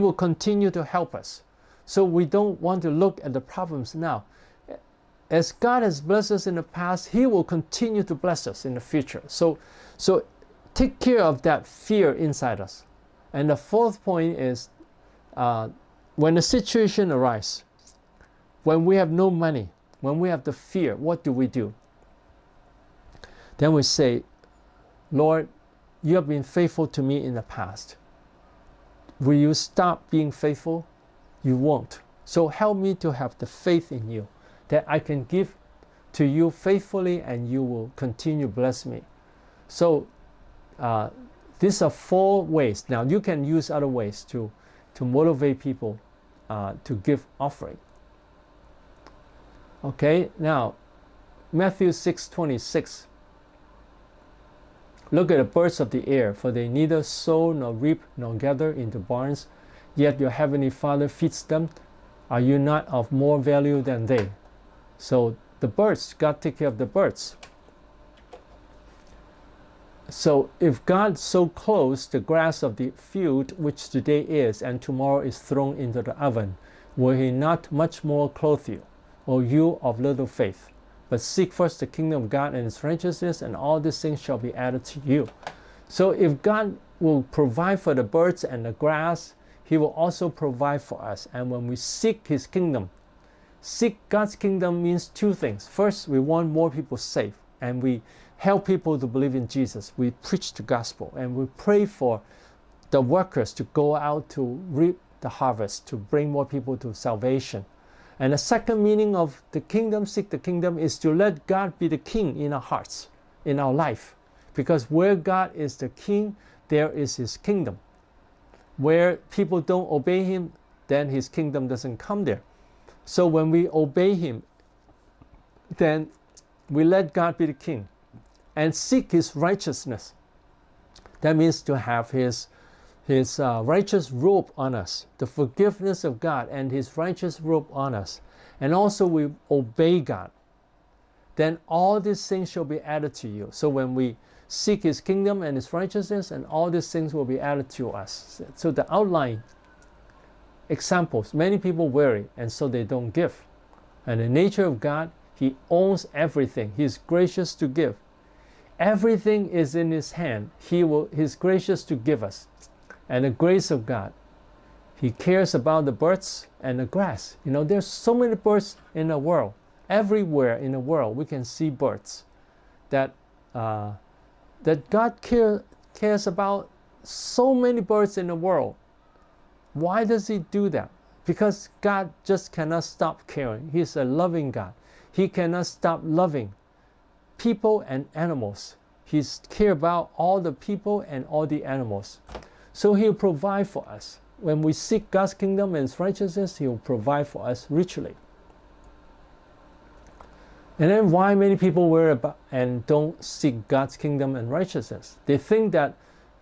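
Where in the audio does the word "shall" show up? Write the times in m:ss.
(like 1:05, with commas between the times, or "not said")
1:24, 2:22.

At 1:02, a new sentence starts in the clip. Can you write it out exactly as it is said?
Are you not of more value than they?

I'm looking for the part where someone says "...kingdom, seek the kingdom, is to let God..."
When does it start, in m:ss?
1:49.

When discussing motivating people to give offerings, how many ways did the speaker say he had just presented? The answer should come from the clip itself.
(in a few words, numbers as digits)
4.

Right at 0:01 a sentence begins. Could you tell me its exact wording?
So we don't want to look at the problems now.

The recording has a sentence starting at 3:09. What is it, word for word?
He care about all the people and all the animals.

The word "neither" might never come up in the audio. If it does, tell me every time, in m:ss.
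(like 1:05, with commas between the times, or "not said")
0:56.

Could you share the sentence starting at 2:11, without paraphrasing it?
That means to have his, his uh, righteous robe on us, the forgiveness of God and his righteous robe on us.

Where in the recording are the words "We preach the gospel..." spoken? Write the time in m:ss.
1:39.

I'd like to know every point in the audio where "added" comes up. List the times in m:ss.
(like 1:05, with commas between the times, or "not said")
1:24, 2:22, 2:27.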